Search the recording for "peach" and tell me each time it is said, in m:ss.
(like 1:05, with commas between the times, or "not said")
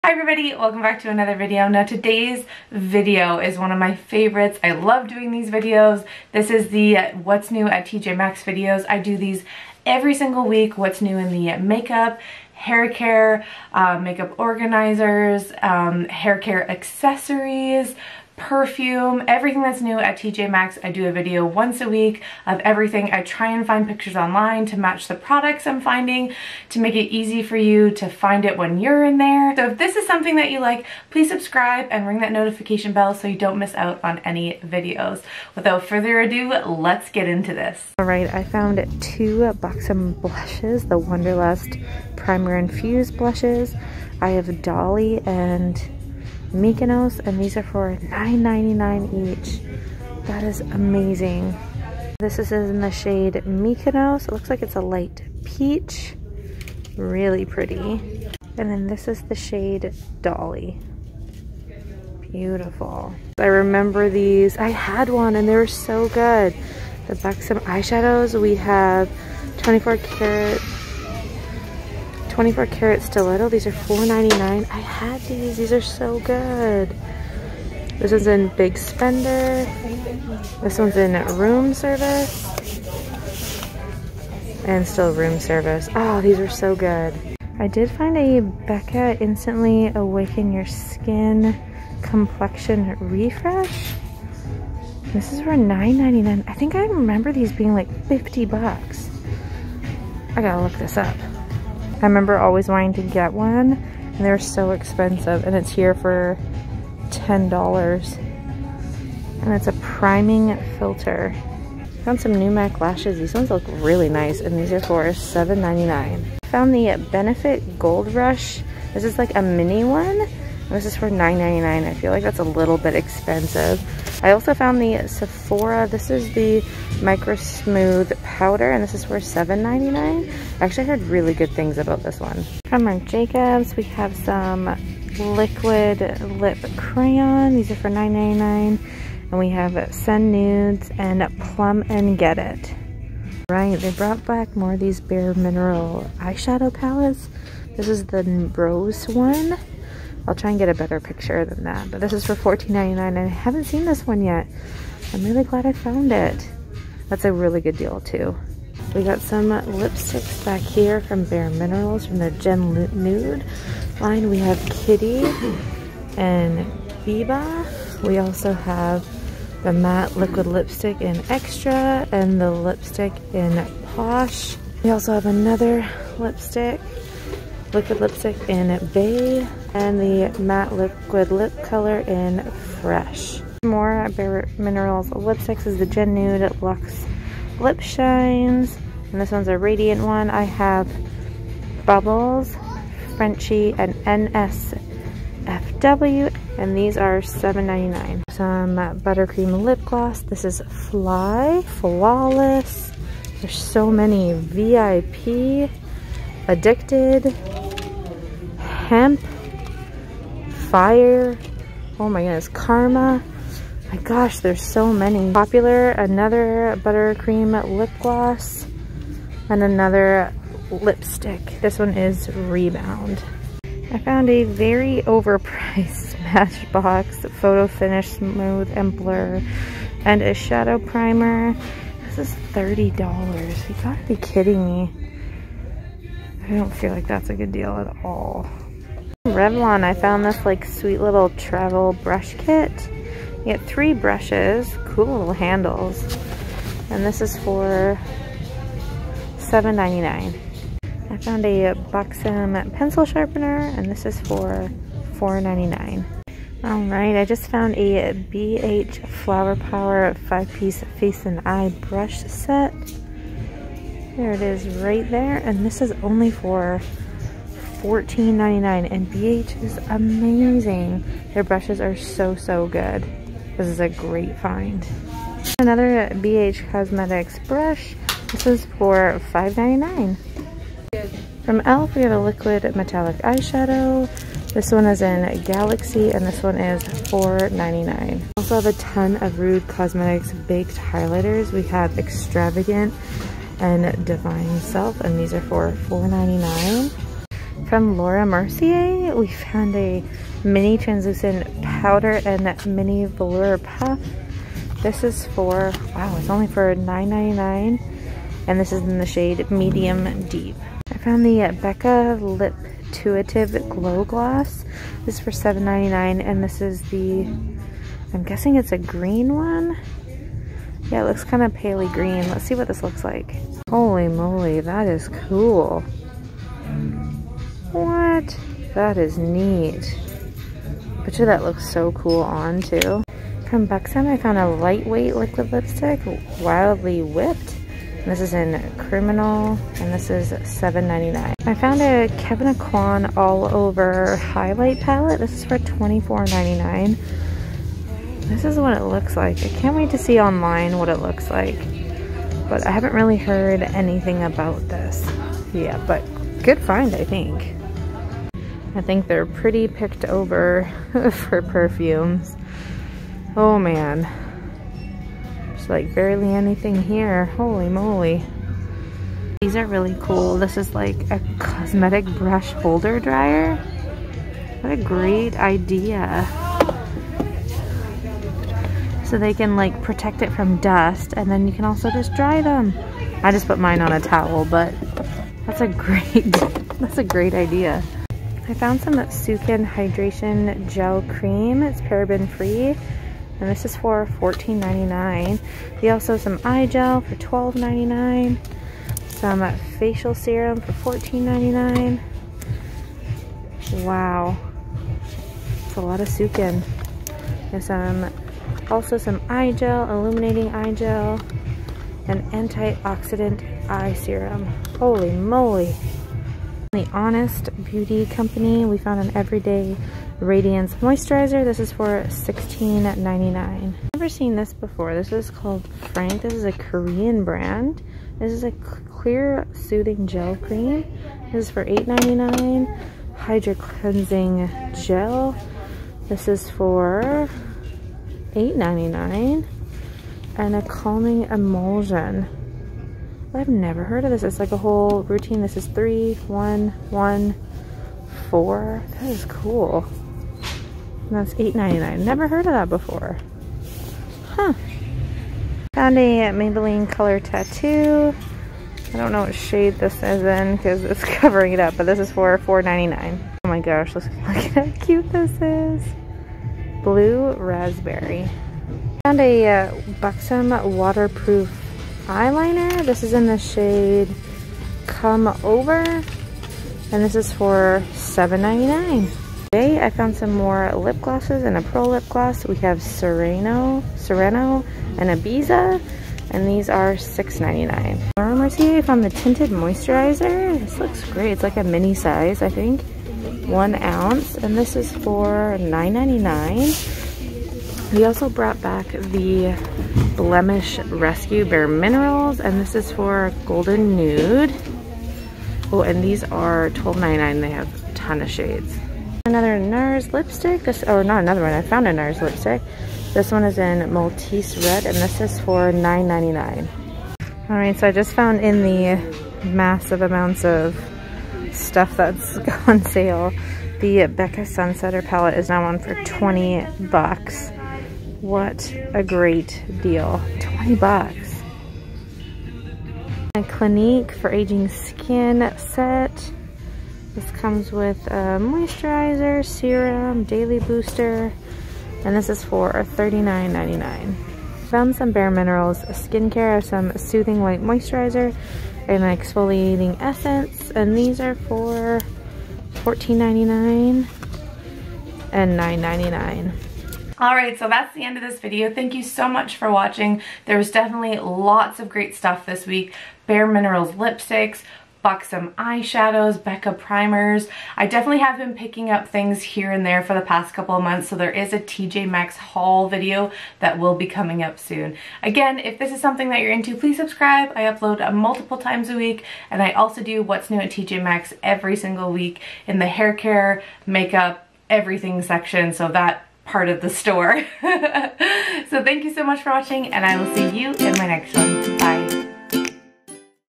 0:55.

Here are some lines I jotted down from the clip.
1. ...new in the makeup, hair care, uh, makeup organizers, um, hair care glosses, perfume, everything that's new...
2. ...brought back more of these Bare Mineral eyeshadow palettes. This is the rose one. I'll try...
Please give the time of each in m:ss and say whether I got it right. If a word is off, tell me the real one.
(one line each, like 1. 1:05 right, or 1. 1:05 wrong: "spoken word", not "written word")
1. 0:11 wrong: "accessories", not "glosses"
2. 2:23 right.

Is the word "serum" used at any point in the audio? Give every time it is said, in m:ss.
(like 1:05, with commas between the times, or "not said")
6:40, 6:53, 8:59.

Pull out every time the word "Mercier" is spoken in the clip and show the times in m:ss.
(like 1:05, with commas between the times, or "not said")
4:58, 8:08.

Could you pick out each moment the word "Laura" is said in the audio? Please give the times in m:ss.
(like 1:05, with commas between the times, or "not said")
4:57, 8:08.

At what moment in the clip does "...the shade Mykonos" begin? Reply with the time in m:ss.
0:52.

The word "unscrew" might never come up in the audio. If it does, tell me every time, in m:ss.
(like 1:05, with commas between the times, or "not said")
not said.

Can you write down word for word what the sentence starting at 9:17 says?
Alright, so that's the end of this video.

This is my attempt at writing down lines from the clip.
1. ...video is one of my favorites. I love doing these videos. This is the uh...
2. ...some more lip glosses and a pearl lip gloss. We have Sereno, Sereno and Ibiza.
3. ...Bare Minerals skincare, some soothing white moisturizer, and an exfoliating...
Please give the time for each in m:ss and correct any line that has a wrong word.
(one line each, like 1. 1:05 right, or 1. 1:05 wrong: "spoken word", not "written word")
1. 0:02 right
2. 8:00 right
3. 9:05 right.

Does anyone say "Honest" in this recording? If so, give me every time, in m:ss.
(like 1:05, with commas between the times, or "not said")
6:56.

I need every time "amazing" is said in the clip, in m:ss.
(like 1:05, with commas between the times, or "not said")
0:50, 4:29.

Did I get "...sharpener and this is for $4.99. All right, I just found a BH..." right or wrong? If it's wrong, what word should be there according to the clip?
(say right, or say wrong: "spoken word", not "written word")
right.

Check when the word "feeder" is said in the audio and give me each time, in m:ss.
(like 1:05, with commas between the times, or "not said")
not said.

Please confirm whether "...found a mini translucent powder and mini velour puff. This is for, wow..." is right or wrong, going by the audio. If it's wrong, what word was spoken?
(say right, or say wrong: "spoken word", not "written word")
right.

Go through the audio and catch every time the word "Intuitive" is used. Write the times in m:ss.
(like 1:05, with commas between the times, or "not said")
5:12.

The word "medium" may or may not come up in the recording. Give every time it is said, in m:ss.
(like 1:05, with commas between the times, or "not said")
5:09.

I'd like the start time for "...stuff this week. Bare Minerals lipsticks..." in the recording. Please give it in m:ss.
9:22.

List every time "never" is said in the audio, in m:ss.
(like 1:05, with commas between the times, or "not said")
7:03, 7:23, 7:31.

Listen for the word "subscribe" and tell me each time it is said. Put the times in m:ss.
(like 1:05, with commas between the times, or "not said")
0:31, 9:36.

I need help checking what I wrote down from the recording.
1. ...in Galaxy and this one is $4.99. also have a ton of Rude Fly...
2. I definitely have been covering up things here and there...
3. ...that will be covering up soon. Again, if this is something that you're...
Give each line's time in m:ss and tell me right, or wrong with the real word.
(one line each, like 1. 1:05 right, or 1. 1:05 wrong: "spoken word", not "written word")
1. 4:45 wrong: "Cosmetics", not "Fly"
2. 9:27 wrong: "picking", not "covering"
3. 9:33 wrong: "coming", not "covering".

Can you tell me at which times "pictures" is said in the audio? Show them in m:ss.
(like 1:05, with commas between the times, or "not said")
0:23, 2:30, 5:31.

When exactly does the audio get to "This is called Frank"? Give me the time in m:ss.
7:04.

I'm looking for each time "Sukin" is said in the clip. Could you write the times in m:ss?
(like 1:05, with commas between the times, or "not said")
6:28, 6:46.